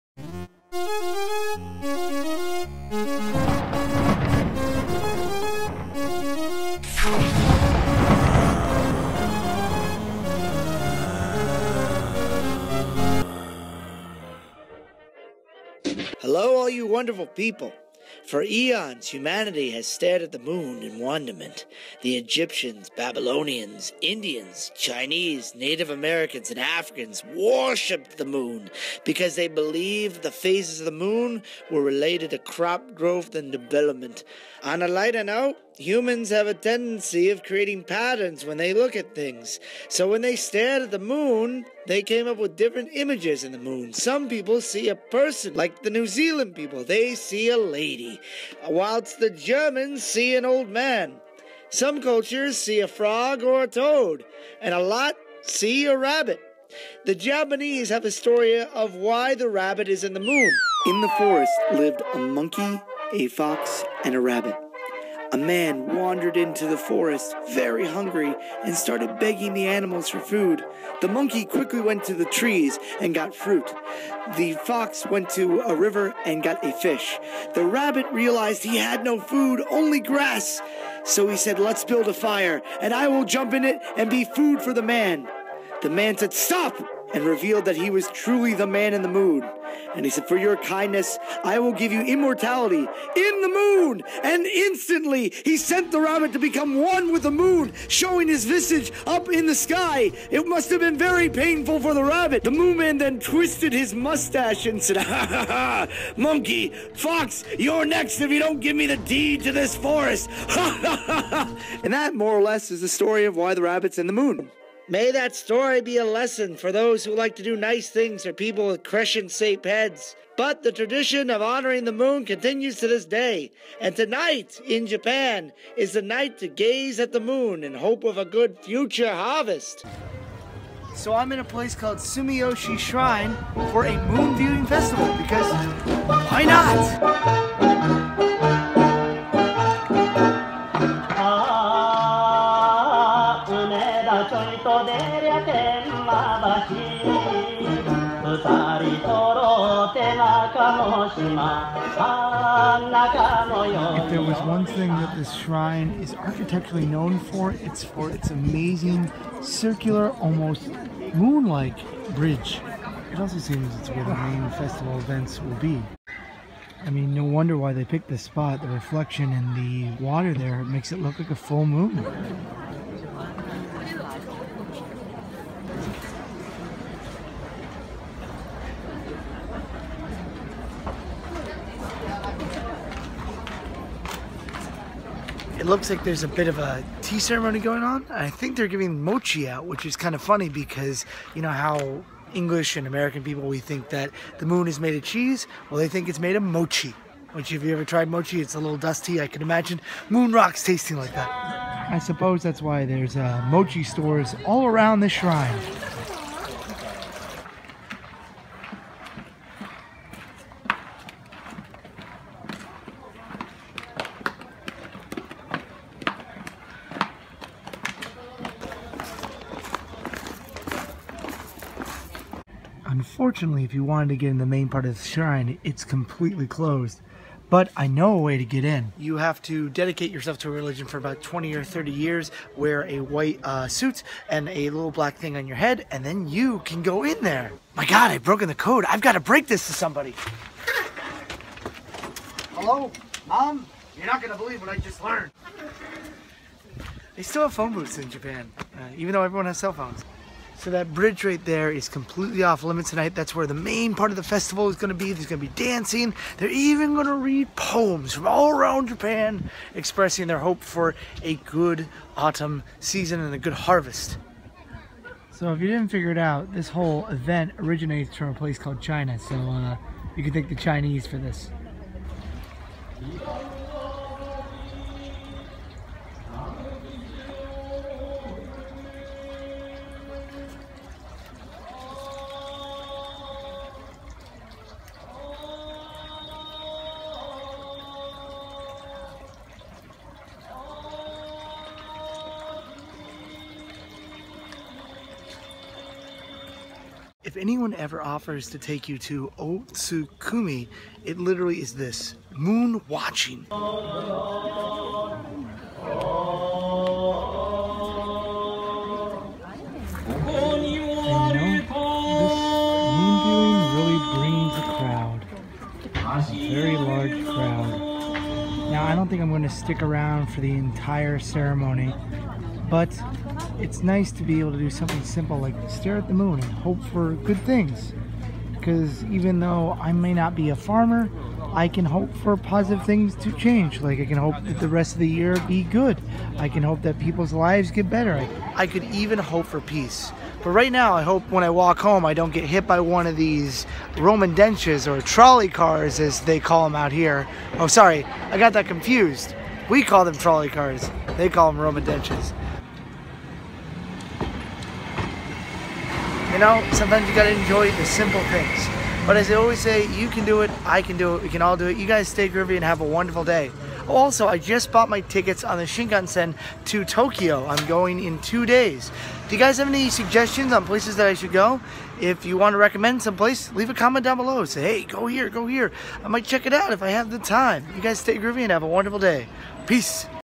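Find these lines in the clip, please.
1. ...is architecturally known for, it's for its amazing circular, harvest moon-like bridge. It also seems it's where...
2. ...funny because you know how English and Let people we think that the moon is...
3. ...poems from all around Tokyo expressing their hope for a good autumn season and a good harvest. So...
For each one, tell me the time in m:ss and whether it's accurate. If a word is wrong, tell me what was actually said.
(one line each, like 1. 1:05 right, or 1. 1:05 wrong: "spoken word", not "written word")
1. 2:35 wrong: "almost", not "harvest"
2. 3:10 wrong: "American", not "Let"
3. 4:17 wrong: "Japan", not "Tokyo".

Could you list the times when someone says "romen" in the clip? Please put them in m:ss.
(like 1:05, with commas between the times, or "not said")
5:43, 5:51.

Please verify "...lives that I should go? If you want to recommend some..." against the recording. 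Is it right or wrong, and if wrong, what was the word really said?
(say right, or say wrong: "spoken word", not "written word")
wrong: "places", not "lives".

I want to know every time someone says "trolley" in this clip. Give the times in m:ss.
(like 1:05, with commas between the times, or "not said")
5:45, 5:50.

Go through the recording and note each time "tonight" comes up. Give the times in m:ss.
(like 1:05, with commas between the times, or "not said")
2:03, 4:12.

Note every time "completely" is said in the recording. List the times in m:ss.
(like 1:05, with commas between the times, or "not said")
3:45, 4:11.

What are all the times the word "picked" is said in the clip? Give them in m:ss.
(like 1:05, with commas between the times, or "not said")
2:47.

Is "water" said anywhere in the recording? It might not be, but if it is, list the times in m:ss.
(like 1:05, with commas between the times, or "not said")
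2:50.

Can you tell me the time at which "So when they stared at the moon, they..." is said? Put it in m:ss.
0:39.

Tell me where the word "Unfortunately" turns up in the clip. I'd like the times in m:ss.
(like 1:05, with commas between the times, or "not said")
3:43.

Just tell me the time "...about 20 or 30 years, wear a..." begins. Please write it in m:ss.
3:50.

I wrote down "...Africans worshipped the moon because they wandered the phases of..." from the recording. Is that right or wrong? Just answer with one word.
wrong.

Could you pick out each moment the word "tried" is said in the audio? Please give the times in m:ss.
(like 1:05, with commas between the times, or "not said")
3:17.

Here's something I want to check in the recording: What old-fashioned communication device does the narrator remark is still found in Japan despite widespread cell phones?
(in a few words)
phone booths.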